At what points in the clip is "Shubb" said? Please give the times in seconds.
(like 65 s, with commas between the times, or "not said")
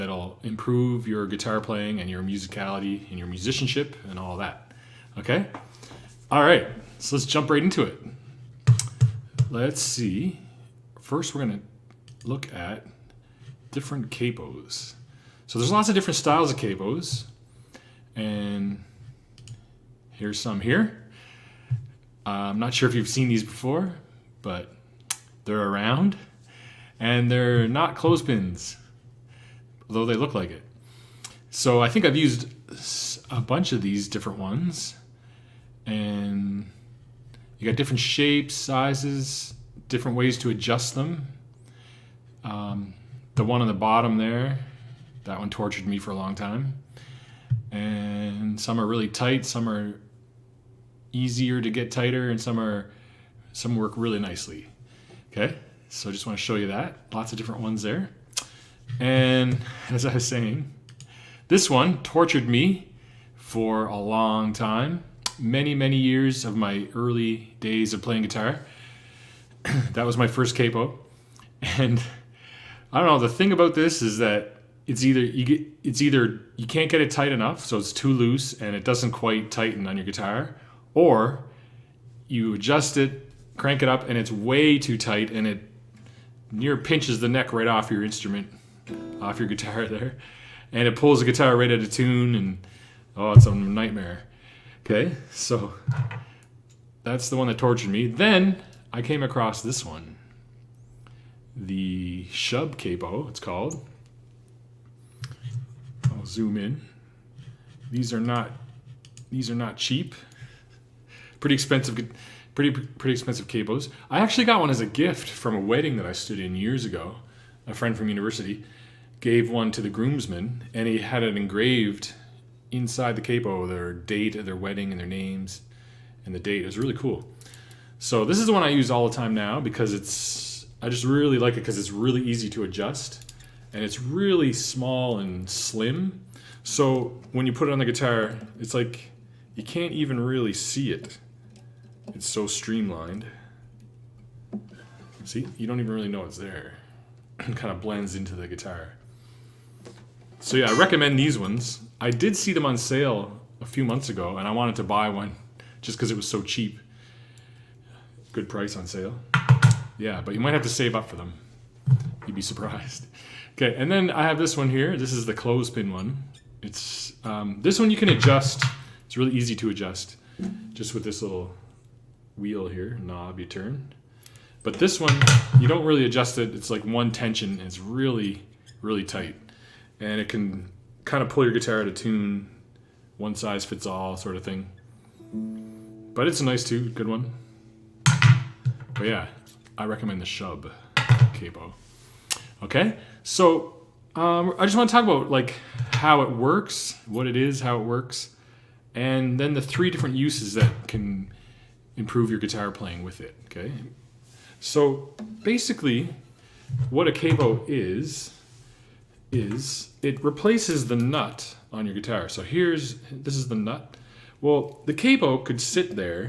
102 s, 190 s.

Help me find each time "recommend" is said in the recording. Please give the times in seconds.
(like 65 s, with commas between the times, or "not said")
150 s, 189 s.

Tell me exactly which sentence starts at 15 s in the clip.
So there's lots of different styles of capos.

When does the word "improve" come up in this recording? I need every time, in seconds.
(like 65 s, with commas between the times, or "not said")
0 s, 201 s.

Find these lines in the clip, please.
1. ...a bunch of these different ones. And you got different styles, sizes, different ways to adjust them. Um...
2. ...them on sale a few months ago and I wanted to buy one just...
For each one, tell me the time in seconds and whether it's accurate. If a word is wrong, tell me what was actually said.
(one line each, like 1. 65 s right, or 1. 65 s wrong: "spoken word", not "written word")
1. 33 s wrong: "shapes", not "styles"
2. 152 s right.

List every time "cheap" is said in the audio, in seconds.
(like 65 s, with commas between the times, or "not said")
109 s, 156 s.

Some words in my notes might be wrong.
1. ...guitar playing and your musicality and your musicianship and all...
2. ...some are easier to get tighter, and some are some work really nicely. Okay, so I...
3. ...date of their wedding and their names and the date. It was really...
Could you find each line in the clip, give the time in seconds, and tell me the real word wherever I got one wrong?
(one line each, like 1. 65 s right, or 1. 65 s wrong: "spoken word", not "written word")
1. 1 s right
2. 49 s right
3. 123 s right.